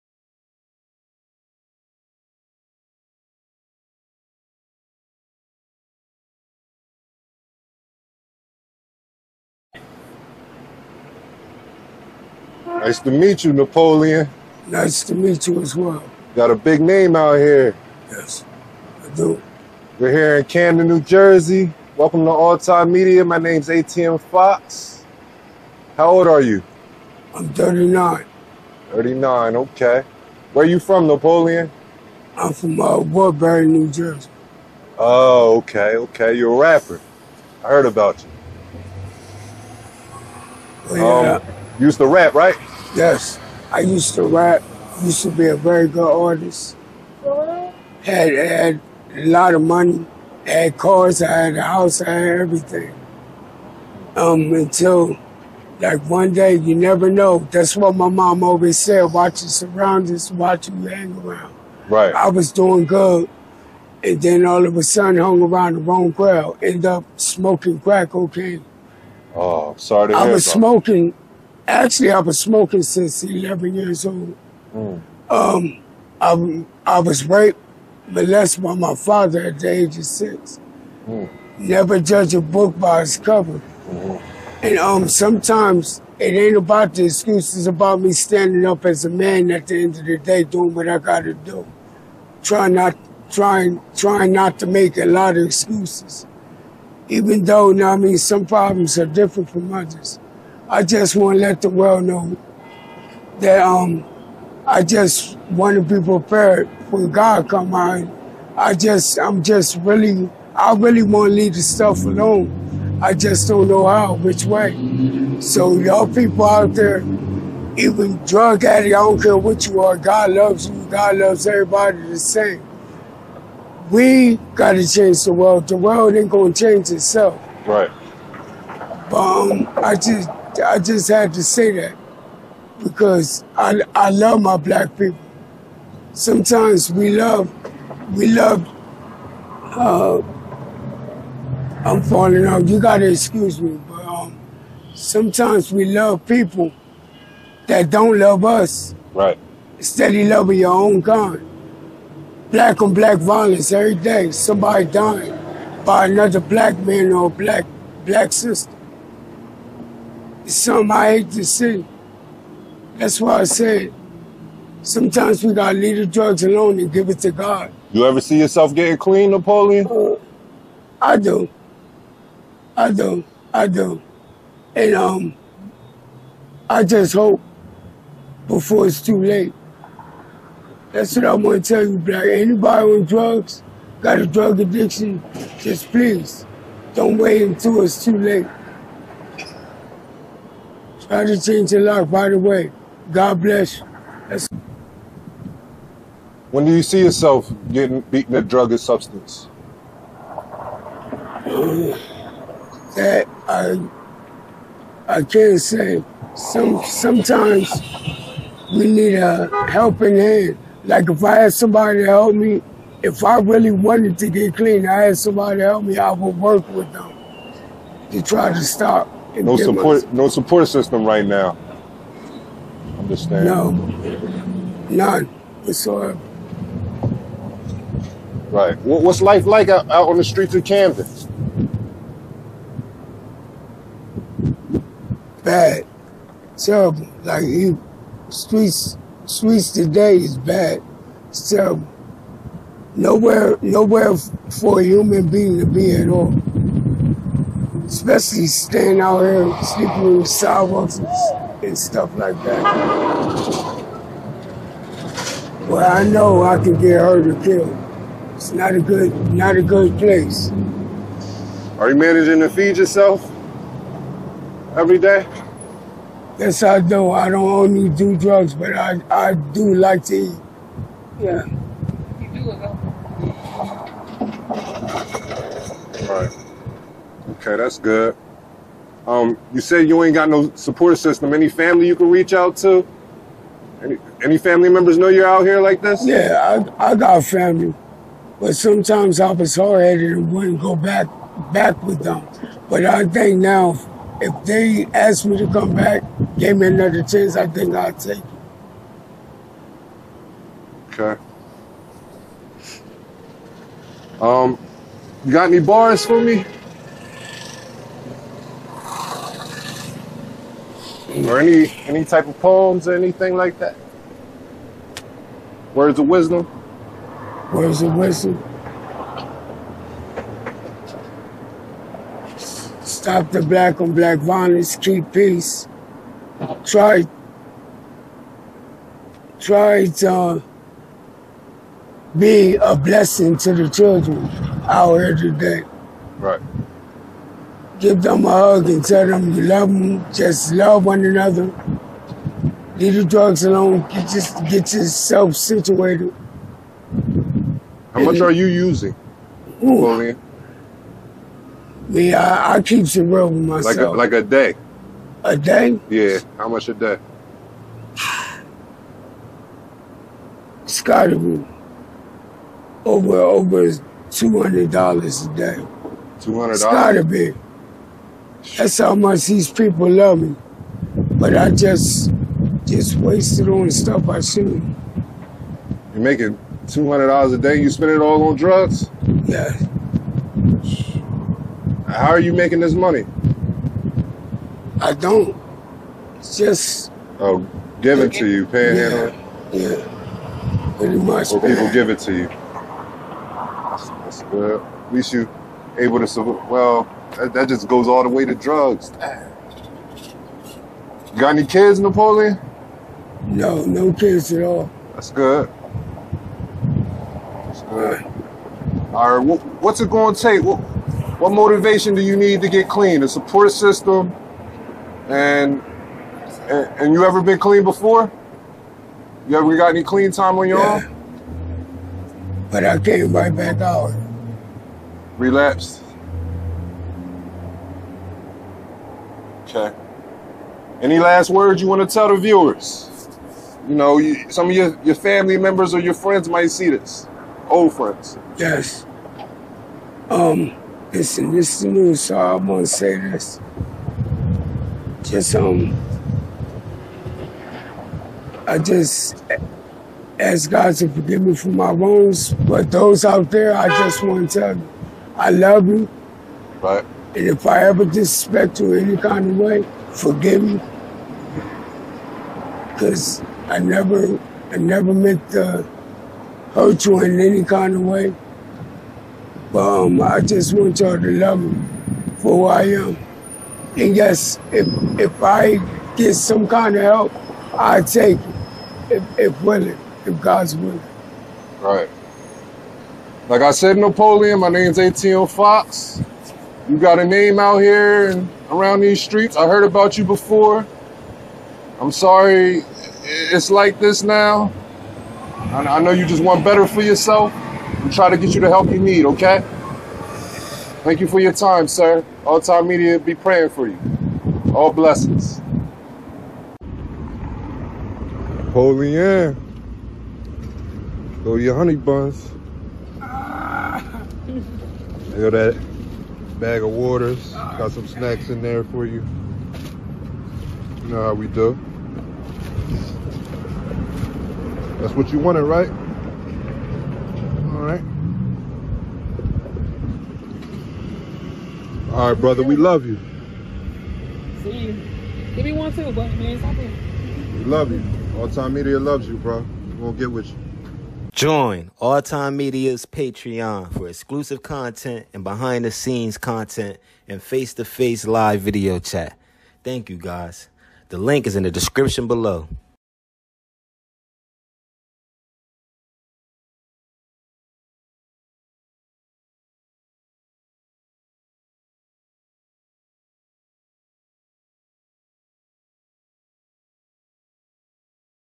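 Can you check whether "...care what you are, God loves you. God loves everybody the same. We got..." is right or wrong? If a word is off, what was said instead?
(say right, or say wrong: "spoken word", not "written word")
right.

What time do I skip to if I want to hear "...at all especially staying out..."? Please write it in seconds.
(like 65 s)
245 s.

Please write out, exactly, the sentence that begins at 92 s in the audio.
Trying not, trying, trying not to make a lot of excuses.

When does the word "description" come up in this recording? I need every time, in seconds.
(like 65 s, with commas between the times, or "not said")
551 s.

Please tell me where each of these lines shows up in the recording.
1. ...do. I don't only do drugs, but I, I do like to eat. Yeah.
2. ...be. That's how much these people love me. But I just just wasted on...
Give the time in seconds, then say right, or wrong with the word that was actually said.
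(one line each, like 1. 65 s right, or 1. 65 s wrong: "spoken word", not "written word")
1. 266 s right
2. 367 s right.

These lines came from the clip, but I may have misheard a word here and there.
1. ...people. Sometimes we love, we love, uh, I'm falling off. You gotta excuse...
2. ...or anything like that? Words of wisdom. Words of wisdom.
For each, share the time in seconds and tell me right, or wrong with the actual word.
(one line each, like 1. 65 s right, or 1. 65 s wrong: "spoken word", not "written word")
1. 134 s right
2. 312 s right.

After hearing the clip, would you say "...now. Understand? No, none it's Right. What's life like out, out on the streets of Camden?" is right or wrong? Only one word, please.
right.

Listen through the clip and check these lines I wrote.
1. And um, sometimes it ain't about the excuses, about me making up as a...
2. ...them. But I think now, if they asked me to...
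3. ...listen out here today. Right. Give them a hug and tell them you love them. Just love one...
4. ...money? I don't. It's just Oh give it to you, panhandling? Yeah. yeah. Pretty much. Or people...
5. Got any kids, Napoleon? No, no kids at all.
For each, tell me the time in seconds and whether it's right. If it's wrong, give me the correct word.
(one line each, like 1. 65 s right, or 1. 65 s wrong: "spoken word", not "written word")
1. 84 s wrong: "standing", not "making"
2. 292 s right
3. 333 s wrong: "children", not "listen"
4. 382 s right
5. 401 s right.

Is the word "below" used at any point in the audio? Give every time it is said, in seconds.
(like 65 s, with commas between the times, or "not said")
552 s.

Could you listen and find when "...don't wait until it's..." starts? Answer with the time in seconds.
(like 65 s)
186 s.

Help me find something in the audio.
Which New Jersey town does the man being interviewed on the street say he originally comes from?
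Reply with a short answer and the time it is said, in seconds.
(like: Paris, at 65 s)
Woodbury, at 32 s.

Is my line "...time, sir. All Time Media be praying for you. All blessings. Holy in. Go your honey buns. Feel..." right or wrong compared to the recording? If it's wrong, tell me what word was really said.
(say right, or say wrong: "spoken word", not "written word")
right.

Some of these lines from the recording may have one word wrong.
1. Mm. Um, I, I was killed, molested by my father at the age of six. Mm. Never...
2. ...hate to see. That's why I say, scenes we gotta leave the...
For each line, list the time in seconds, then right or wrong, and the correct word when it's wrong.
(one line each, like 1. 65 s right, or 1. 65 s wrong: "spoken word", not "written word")
1. 74 s wrong: "raped", not "killed"
2. 161 s wrong: "sometimes", not "scenes".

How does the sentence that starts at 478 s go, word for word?
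If, if willing, if God's willing.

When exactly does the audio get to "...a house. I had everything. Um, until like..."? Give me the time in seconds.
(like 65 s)
51 s.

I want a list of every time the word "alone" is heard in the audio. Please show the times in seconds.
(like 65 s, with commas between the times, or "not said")
112 s, 166 s, 343 s.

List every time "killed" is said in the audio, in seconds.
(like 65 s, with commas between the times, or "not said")
257 s.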